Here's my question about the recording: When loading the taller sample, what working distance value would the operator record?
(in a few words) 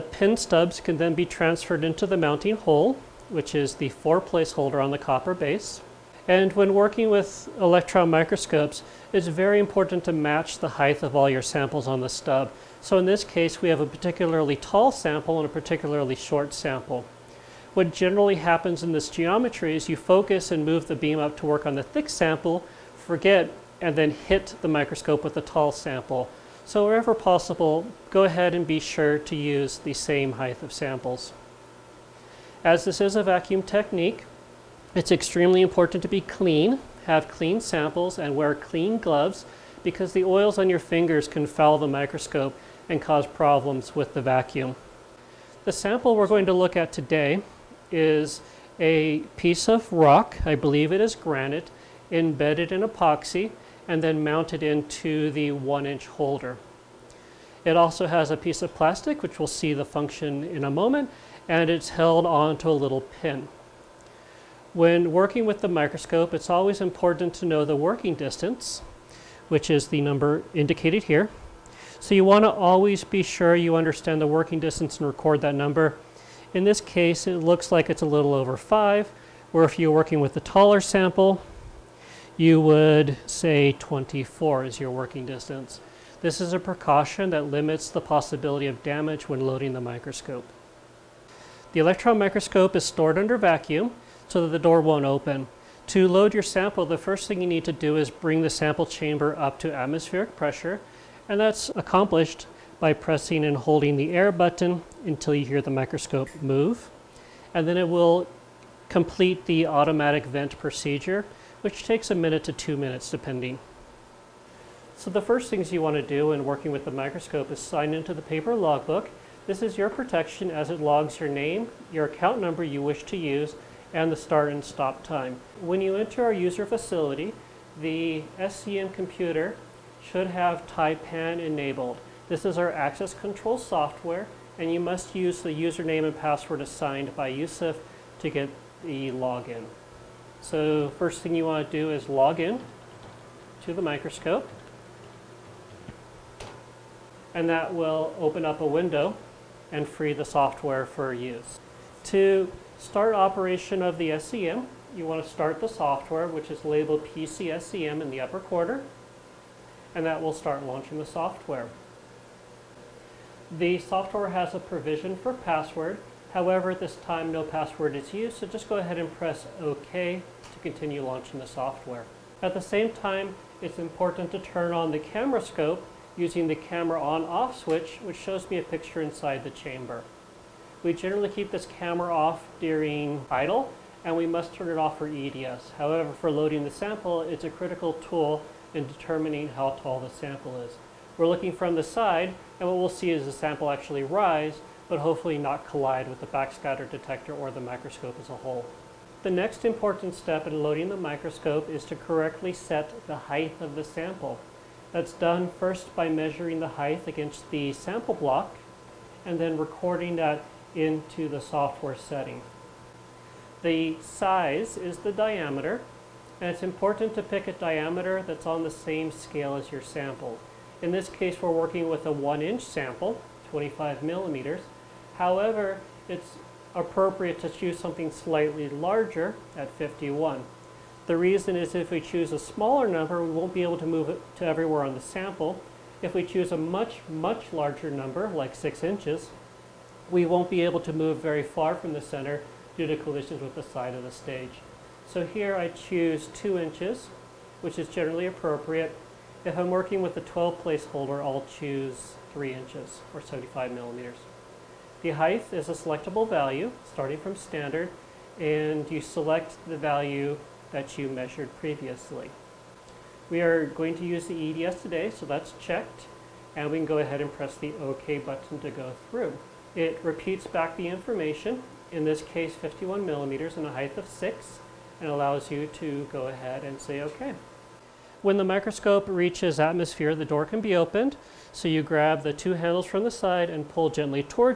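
24.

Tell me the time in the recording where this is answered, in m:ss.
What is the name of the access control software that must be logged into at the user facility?
2:10.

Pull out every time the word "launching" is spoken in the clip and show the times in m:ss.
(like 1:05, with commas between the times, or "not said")
2:40, 2:51.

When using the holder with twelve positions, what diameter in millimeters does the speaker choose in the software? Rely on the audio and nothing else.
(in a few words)
75.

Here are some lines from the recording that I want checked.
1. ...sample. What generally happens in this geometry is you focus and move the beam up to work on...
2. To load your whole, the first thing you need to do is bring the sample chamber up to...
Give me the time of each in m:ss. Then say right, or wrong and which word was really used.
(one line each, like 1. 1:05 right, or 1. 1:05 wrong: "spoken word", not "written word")
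1. 0:16 right
2. 1:35 wrong: "sample", not "whole".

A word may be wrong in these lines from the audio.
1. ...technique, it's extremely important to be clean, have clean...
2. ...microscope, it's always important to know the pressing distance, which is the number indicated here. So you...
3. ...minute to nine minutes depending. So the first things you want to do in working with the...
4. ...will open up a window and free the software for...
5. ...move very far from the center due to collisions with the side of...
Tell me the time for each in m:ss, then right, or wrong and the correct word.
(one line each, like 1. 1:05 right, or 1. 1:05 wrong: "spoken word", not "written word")
1. 0:33 right
2. 1:05 wrong: "working", not "pressing"
3. 1:52 wrong: "two", not "nine"
4. 2:27 right
5. 4:00 right.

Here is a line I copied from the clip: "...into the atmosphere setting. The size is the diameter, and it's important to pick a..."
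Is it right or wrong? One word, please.
wrong.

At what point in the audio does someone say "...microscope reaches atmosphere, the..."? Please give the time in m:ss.
4:38.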